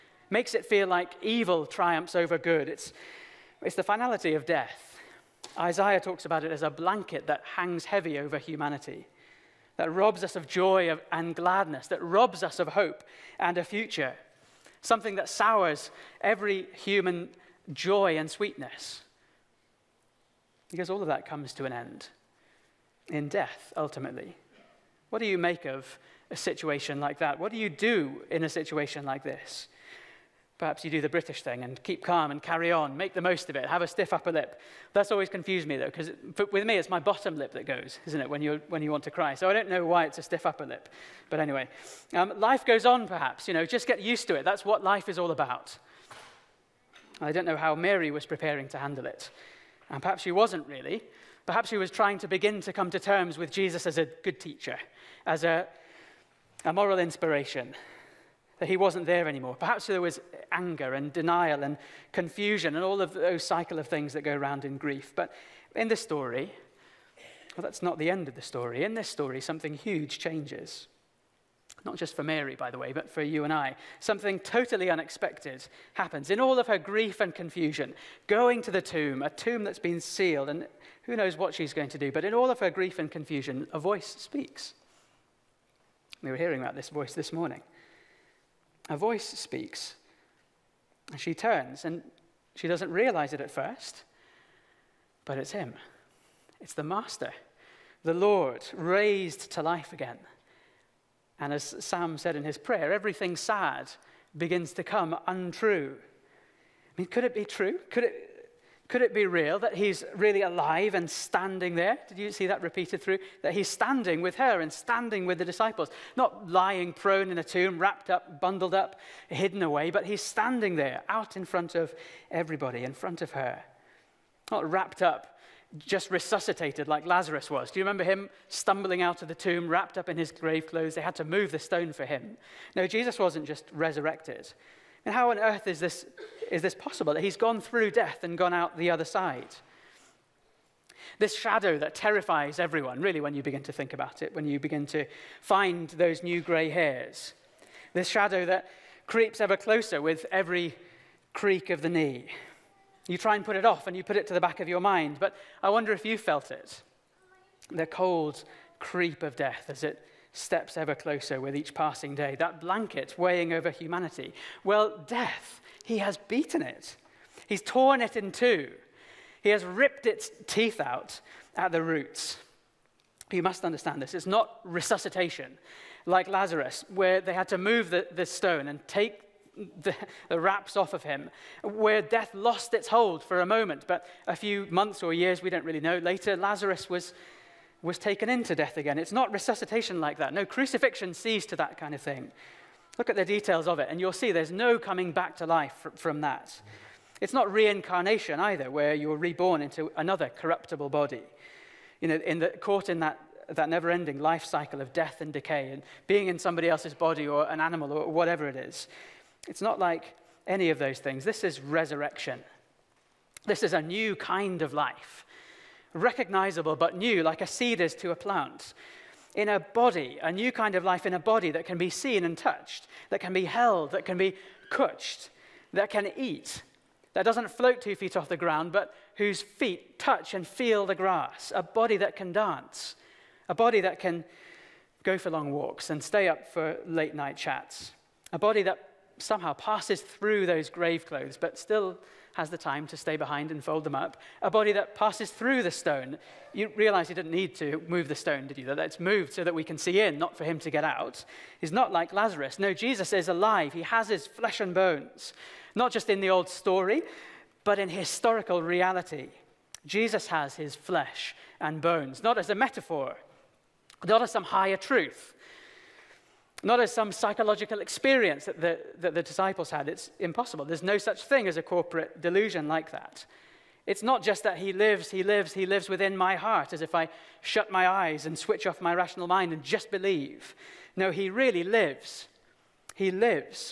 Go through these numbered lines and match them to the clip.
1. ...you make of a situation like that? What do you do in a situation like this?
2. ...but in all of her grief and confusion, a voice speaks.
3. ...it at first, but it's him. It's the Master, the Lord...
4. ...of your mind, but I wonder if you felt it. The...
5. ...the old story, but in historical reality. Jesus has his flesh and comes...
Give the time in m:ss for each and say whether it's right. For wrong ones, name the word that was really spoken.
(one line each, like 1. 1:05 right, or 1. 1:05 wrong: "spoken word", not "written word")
1. 0:25 right
2. 1:22 right
3. 1:33 right
4. 2:34 right
5. 4:16 wrong: "bones", not "comes".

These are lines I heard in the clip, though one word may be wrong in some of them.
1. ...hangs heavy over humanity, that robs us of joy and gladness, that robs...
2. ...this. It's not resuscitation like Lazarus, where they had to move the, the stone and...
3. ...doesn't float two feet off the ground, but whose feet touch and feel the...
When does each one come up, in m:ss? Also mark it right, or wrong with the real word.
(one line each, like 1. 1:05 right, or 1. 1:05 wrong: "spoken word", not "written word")
1. 0:07 right
2. 2:54 right
3. 3:47 right.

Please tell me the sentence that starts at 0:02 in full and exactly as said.
It's, it's the finality of death.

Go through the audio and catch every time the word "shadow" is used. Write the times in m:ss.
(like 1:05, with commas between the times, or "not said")
2:21, 2:28.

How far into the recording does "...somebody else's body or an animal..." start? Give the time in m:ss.
3:26.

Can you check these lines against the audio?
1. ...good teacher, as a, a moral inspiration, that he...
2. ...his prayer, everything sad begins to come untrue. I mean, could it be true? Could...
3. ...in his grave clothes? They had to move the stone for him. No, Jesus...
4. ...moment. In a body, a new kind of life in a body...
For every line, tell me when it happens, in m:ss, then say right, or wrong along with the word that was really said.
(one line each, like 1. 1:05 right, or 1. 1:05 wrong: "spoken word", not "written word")
1. 0:54 right
2. 1:42 right
3. 2:10 right
4. 3:38 wrong: "plant", not "moment".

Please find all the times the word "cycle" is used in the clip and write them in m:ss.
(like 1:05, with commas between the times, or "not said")
1:03, 3:24.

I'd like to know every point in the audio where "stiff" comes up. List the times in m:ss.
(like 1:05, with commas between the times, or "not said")
0:33, 0:40.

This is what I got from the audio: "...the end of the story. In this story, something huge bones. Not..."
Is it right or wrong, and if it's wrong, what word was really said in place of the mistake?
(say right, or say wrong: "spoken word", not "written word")
wrong: "changes", not "bones".